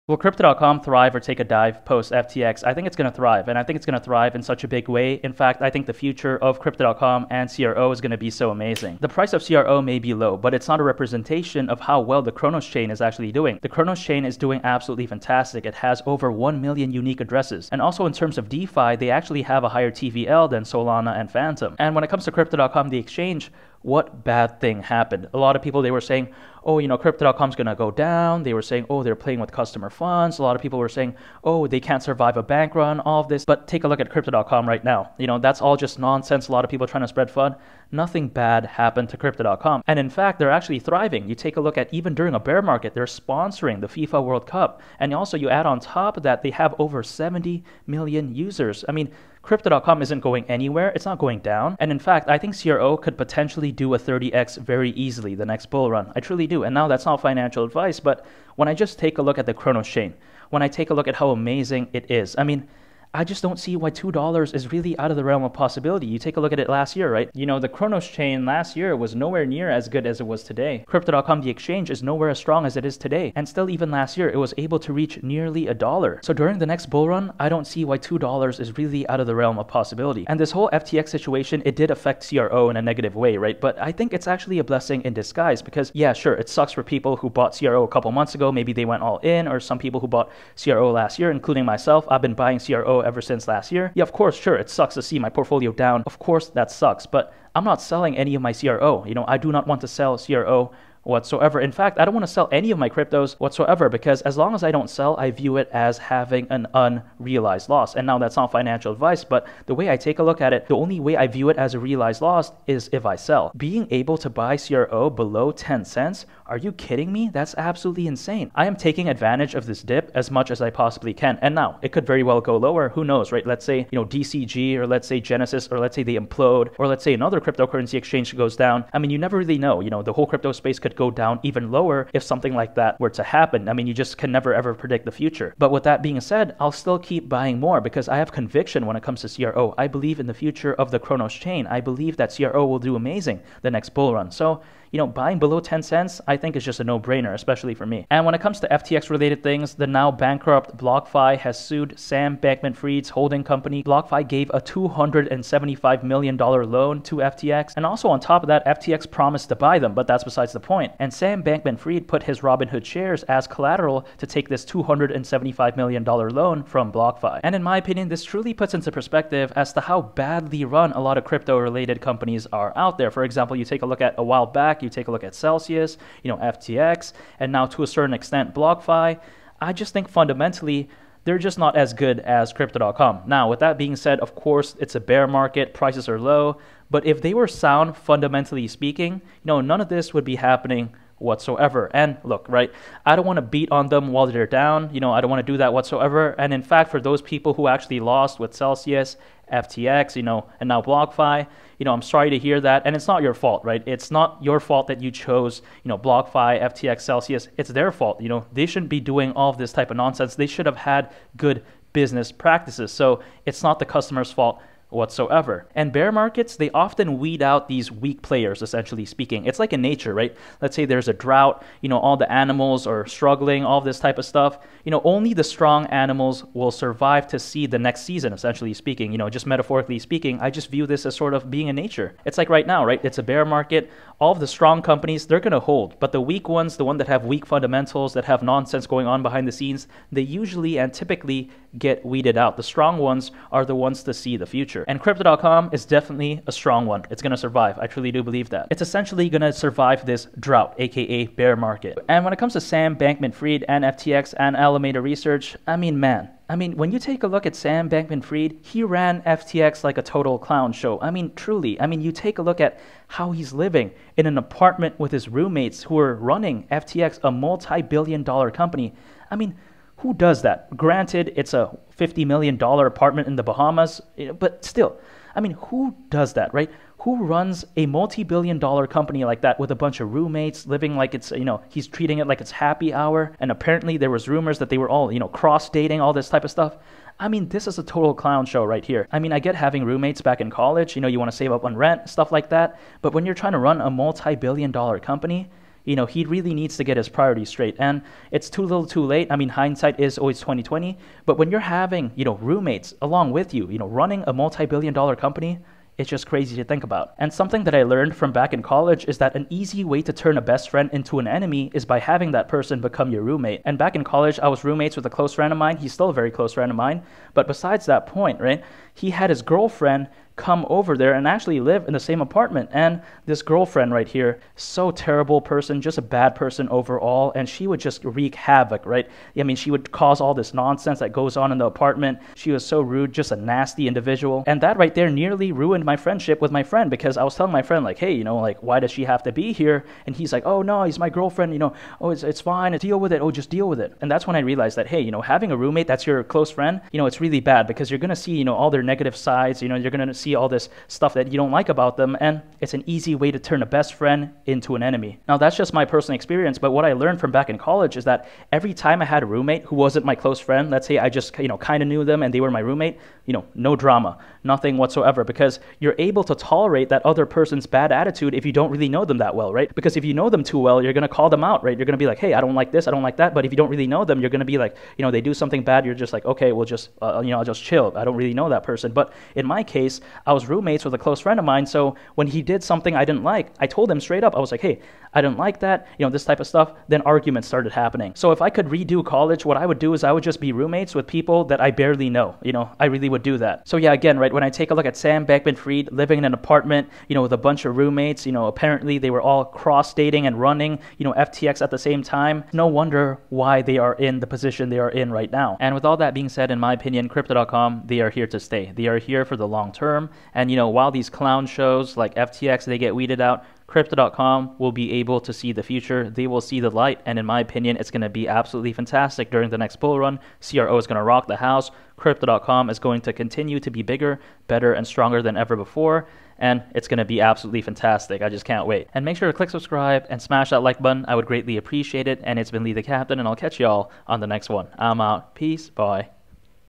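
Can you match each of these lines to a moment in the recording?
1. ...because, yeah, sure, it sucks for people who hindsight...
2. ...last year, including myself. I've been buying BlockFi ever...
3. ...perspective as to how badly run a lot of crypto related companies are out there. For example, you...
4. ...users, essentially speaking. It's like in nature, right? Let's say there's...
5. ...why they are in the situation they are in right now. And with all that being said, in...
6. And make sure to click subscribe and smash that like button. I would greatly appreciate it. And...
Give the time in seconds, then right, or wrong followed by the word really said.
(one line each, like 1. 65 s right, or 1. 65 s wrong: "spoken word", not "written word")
1. 85 s wrong: "bought", not "hindsight"
2. 90 s wrong: "CRO", not "BlockFi"
3. 168 s right
4. 218 s wrong: "players", not "users"
5. 403 s wrong: "position", not "situation"
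6. 428 s right.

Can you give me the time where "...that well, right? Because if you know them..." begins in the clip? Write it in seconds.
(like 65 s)
369 s.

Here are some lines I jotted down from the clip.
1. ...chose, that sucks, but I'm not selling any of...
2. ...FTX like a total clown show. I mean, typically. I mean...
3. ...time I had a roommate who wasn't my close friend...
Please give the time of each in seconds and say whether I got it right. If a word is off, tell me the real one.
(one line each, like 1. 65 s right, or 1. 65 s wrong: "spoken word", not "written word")
1. 96 s wrong: "course", not "chose"
2. 259 s wrong: "truly", not "typically"
3. 358 s right.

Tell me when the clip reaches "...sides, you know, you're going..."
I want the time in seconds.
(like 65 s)
349 s.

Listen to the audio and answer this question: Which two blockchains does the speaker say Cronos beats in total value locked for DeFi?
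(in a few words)
Solana and Fantom.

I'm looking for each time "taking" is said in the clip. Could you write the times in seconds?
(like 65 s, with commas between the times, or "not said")
118 s.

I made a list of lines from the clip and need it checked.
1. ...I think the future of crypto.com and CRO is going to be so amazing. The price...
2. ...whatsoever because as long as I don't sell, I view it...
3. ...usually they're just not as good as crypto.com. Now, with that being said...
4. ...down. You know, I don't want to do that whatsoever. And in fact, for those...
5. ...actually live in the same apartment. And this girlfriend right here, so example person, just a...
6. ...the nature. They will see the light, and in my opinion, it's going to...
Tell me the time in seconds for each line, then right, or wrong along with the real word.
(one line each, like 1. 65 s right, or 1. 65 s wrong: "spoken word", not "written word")
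1. 5 s right
2. 103 s right
3. 180 s wrong: "fundamentally", not "usually"
4. 194 s right
5. 321 s wrong: "terrible", not "example"
6. 415 s wrong: "future", not "nature".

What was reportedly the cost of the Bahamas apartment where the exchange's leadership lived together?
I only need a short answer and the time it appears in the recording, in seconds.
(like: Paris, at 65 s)
$50 million, at 271 s.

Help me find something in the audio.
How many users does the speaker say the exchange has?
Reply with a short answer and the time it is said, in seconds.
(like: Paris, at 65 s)
70 million, at 47 s.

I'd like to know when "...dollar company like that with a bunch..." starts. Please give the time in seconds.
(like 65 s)
278 s.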